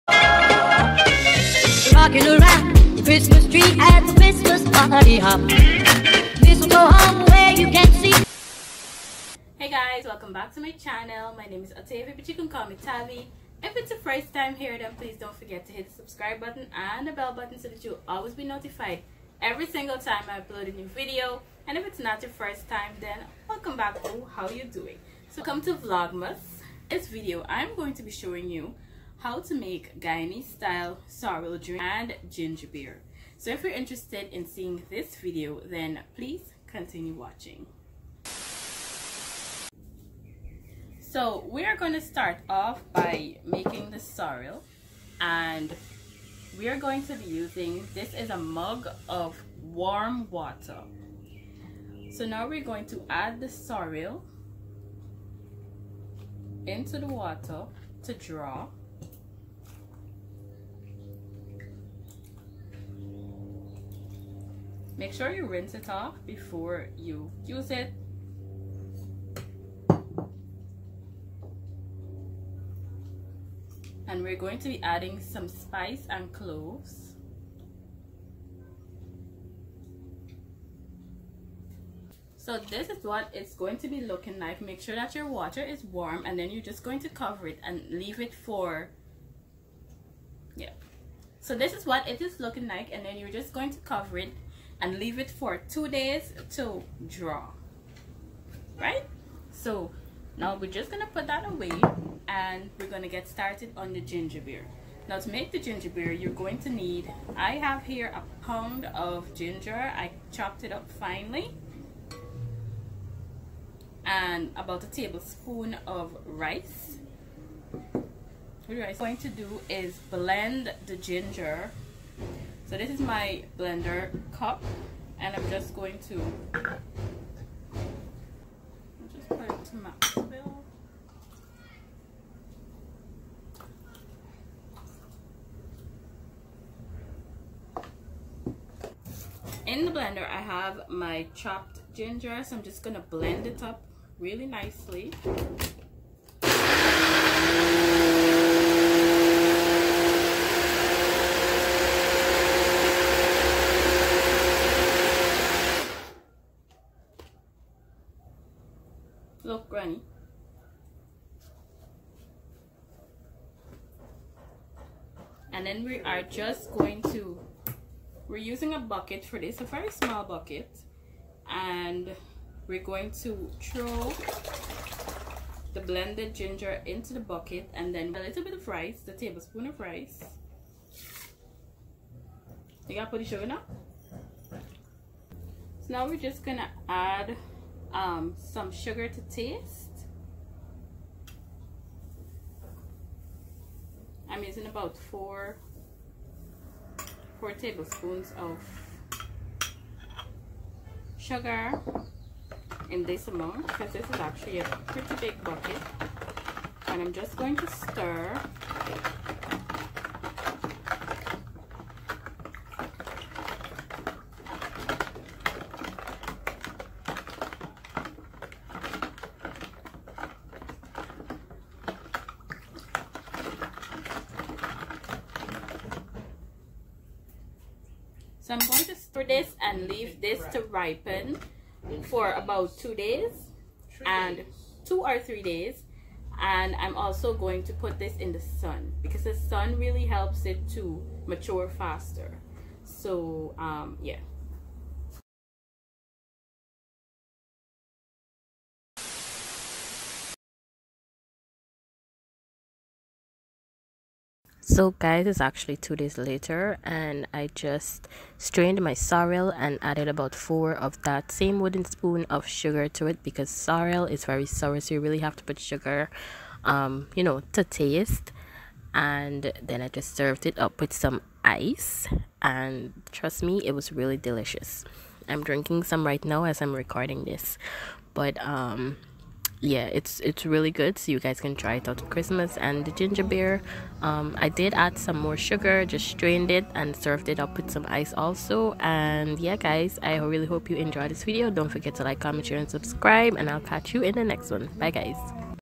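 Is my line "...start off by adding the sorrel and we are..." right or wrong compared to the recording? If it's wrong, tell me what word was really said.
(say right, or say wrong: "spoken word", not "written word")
wrong: "making", not "adding".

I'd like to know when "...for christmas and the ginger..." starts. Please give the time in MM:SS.
04:41.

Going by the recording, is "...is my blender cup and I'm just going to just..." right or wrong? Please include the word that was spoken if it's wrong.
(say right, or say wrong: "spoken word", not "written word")
right.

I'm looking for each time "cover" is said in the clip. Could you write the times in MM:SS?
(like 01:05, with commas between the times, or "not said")
01:27, 01:33.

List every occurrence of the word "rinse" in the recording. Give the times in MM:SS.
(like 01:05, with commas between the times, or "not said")
01:05.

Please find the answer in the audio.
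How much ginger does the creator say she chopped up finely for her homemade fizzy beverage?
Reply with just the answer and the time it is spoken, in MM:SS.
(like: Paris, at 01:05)
a pound, at 01:48.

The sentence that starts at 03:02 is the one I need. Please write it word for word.
You gotta put the sugar now.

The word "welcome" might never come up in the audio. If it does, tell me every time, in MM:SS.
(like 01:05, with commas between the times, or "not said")
00:10, 00:23.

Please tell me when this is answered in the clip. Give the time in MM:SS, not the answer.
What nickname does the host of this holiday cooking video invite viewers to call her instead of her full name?
00:12.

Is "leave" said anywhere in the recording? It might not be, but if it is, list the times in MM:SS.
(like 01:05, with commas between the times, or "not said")
01:27, 01:34, 03:49.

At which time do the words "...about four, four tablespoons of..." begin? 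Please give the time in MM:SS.
03:14.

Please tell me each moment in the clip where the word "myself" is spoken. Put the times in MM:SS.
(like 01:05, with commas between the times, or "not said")
not said.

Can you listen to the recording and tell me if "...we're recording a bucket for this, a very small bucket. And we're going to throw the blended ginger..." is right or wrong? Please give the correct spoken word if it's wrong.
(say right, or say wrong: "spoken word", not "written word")
wrong: "using", not "recording".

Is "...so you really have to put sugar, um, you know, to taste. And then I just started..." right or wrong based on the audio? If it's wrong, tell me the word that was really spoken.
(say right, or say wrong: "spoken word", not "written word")
wrong: "served", not "started".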